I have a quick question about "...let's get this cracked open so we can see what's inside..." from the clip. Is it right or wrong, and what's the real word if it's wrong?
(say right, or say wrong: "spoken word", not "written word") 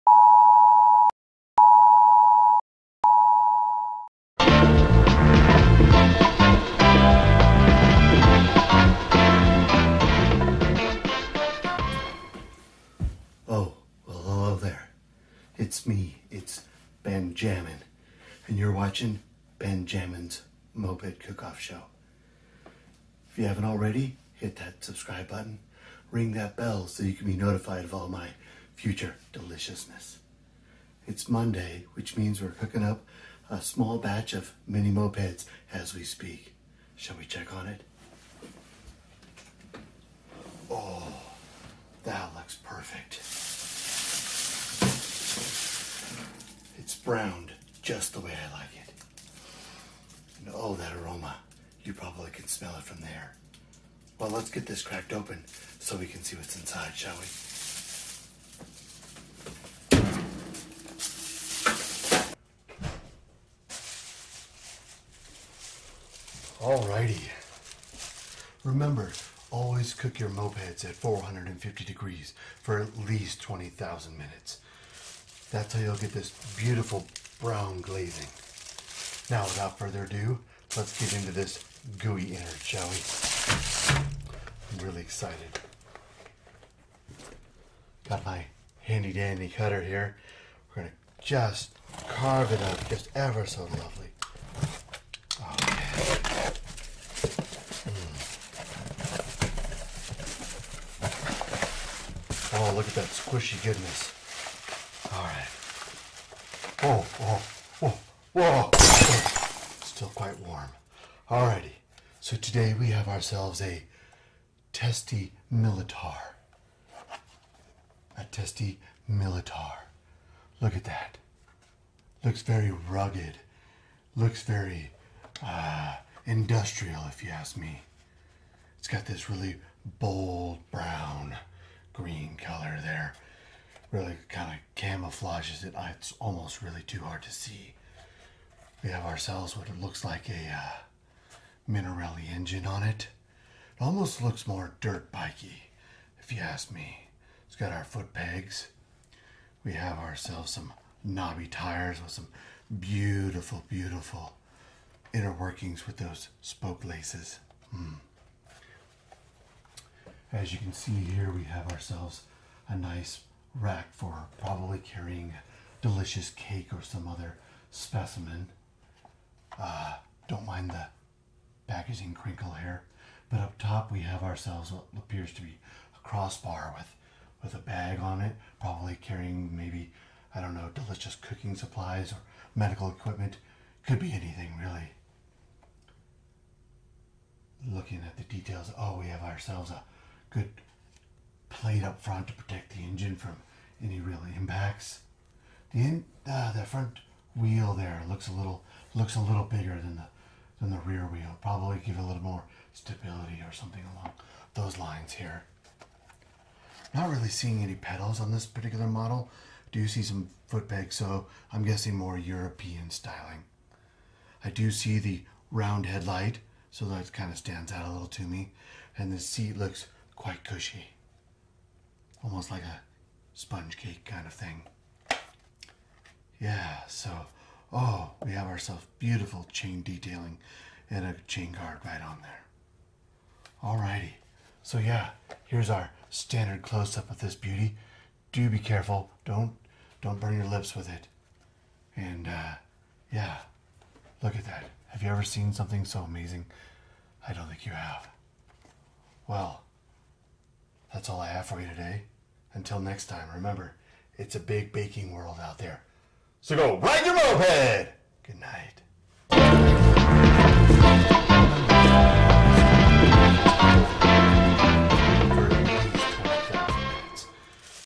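right.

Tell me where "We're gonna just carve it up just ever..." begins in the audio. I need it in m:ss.
1:30.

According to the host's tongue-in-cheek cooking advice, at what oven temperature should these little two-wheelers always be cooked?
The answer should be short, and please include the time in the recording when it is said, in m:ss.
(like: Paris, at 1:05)
450 degrees, at 1:10.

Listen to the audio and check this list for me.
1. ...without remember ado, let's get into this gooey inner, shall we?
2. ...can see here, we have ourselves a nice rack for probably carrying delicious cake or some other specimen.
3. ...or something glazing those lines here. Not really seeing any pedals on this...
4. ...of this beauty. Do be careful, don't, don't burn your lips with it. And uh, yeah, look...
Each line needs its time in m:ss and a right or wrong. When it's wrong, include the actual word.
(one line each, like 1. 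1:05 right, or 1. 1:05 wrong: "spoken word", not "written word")
1. 1:19 wrong: "further", not "remember"
2. 2:40 right
3. 3:23 wrong: "along", not "glazing"
4. 3:57 right.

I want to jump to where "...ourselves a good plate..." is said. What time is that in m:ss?
3:09.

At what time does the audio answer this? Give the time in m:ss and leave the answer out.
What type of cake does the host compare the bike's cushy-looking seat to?
3:43.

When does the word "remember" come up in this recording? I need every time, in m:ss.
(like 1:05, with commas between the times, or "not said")
1:08, 4:13.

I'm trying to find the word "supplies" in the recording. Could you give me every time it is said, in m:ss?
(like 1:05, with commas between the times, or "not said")
3:01.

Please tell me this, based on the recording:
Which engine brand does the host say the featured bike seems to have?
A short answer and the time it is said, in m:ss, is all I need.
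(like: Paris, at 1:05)
Minarelli, at 2:21.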